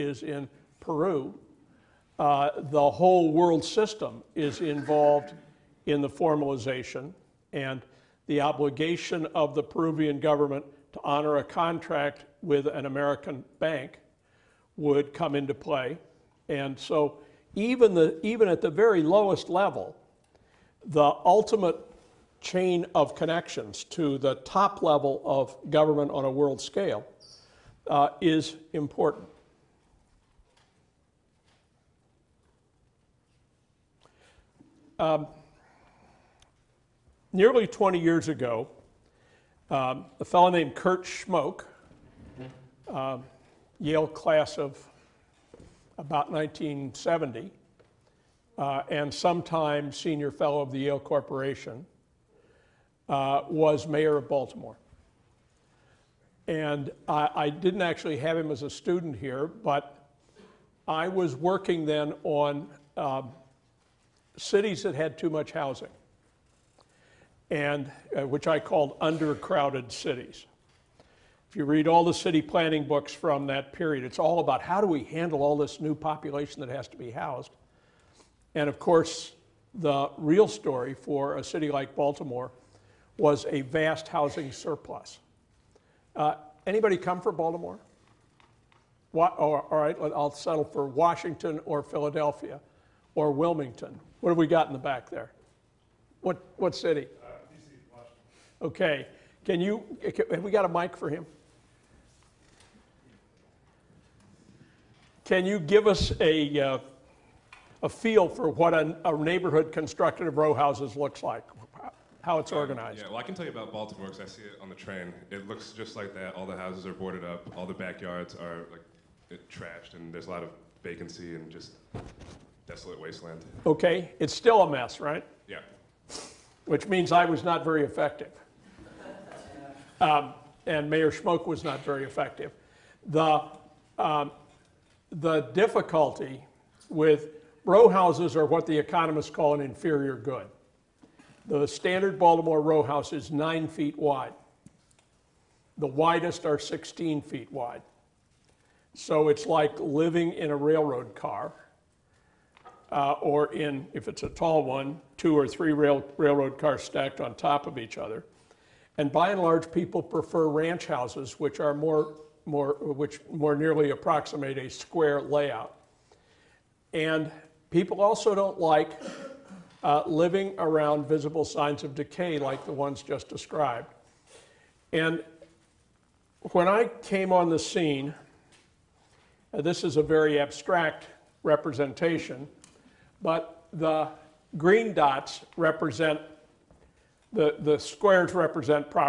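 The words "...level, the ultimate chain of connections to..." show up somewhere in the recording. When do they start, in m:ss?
0:19.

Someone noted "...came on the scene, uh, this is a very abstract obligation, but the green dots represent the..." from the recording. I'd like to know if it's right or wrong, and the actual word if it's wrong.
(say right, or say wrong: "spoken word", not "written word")
wrong: "representation", not "obligation".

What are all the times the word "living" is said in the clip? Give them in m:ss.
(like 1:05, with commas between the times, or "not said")
2:29, 2:50.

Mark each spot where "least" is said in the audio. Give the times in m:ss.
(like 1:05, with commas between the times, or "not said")
not said.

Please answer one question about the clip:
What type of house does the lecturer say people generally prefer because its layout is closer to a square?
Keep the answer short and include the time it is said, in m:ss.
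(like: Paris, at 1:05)
ranch houses, at 2:40.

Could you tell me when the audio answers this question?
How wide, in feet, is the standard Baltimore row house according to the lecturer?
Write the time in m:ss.
2:23.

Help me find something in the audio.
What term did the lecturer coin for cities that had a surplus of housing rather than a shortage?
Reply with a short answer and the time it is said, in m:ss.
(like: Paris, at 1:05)
undercrowded cities, at 1:08.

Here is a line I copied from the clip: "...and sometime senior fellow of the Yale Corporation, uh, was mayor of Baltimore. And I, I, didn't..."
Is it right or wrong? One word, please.
right.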